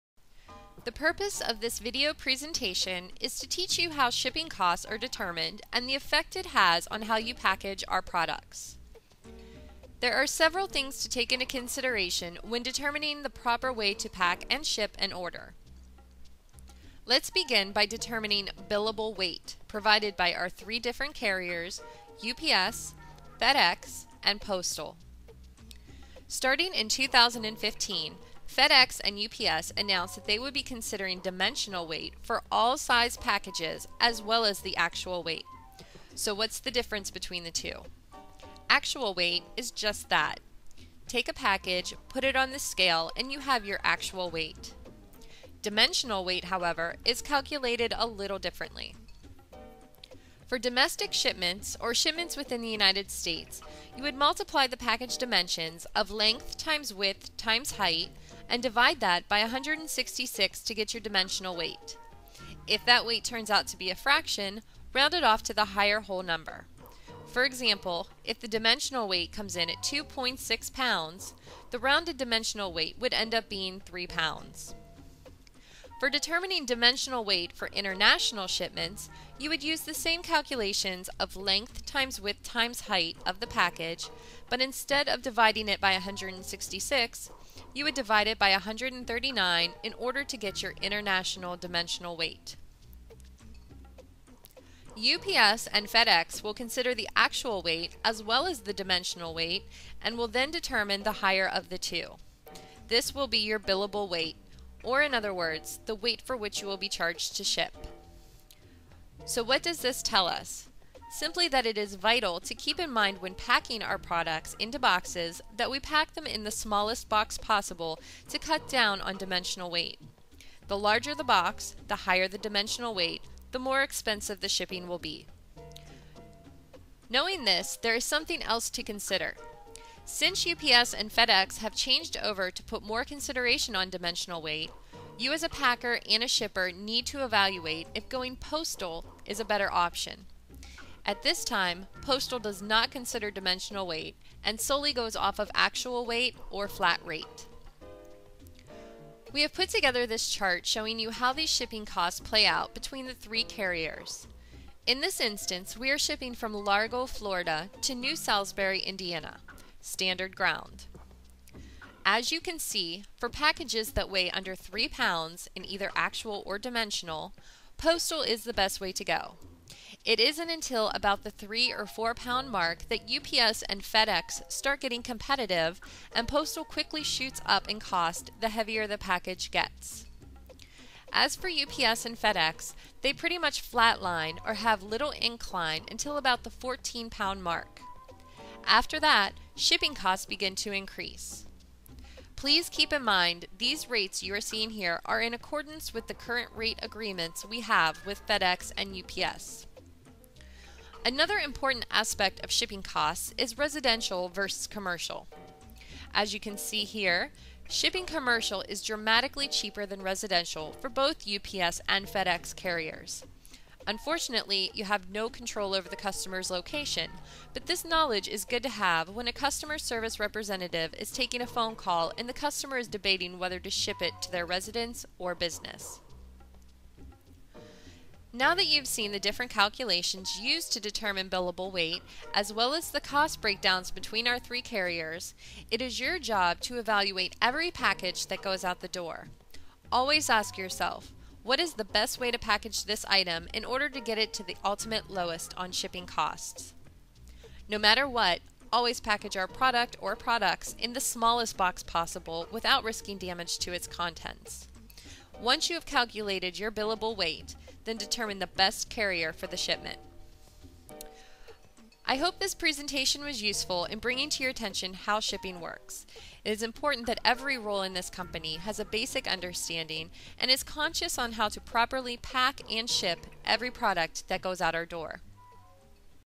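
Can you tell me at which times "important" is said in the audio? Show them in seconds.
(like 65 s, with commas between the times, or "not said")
201 s, 266 s.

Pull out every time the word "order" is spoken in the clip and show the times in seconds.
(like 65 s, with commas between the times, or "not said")
15 s, 89 s, 243 s.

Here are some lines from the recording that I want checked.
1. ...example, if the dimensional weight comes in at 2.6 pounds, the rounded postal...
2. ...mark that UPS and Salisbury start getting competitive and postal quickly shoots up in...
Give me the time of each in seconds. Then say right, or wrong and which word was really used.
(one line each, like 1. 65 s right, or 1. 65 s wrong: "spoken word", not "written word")
1. 67 s wrong: "dimensional", not "postal"
2. 172 s wrong: "FedEx", not "Salisbury".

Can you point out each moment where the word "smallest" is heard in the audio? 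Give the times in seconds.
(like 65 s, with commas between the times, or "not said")
116 s, 250 s.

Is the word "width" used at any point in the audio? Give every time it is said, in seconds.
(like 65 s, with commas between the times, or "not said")
56 s, 82 s.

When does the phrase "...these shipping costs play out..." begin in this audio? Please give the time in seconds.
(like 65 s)
151 s.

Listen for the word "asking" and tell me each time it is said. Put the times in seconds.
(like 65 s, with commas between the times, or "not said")
not said.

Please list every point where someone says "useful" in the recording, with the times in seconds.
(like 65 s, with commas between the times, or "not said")
263 s.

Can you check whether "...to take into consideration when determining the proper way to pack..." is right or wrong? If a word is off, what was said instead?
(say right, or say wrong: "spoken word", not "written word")
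right.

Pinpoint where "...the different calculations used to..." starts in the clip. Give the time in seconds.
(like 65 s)
229 s.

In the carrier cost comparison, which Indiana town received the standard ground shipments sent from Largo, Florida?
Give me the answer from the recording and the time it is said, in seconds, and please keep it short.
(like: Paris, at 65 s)
New Salisbury, at 157 s.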